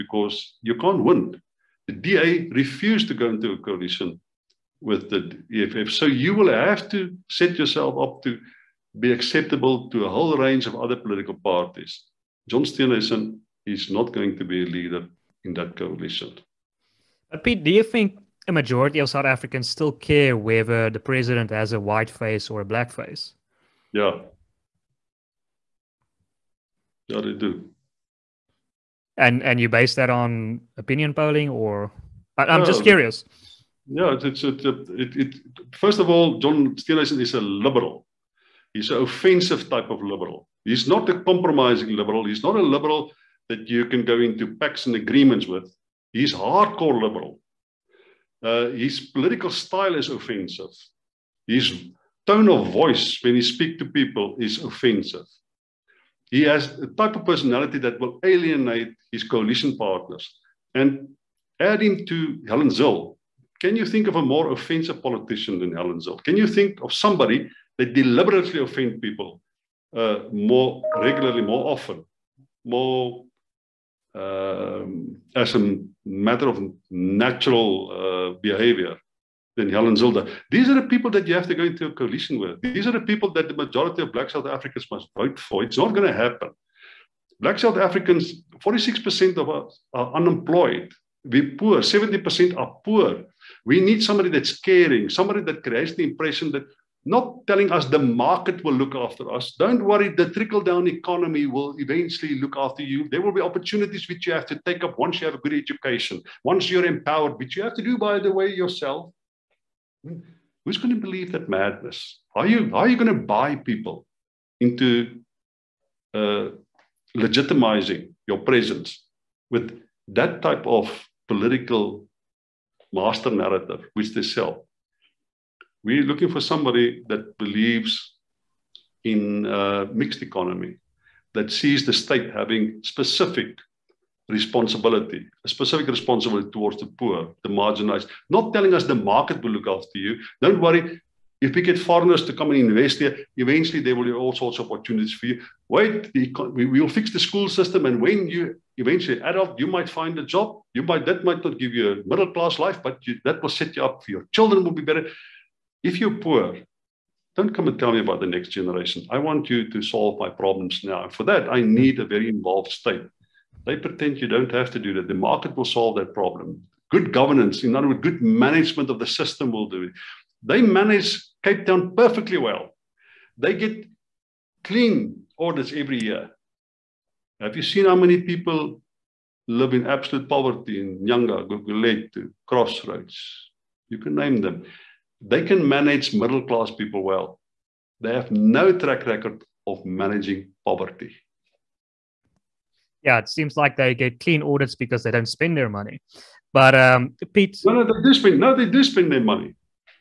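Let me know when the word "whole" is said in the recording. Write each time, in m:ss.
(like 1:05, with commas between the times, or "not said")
0:10.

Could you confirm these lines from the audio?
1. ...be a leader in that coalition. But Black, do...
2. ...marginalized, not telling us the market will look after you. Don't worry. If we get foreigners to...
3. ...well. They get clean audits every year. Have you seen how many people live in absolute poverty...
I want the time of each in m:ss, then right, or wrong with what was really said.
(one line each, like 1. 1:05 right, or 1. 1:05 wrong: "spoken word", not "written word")
1. 0:14 wrong: "Piet", not "Black"
2. 2:17 right
3. 2:52 right.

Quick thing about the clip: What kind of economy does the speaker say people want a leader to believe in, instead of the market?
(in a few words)
mixed economy.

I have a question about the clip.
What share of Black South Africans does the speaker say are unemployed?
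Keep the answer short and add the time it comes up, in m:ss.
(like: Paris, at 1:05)
46%, at 1:28.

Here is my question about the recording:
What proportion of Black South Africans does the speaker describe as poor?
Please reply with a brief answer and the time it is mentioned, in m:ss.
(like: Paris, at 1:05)
70%, at 1:31.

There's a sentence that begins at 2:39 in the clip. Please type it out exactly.
I want you to solve my problems now.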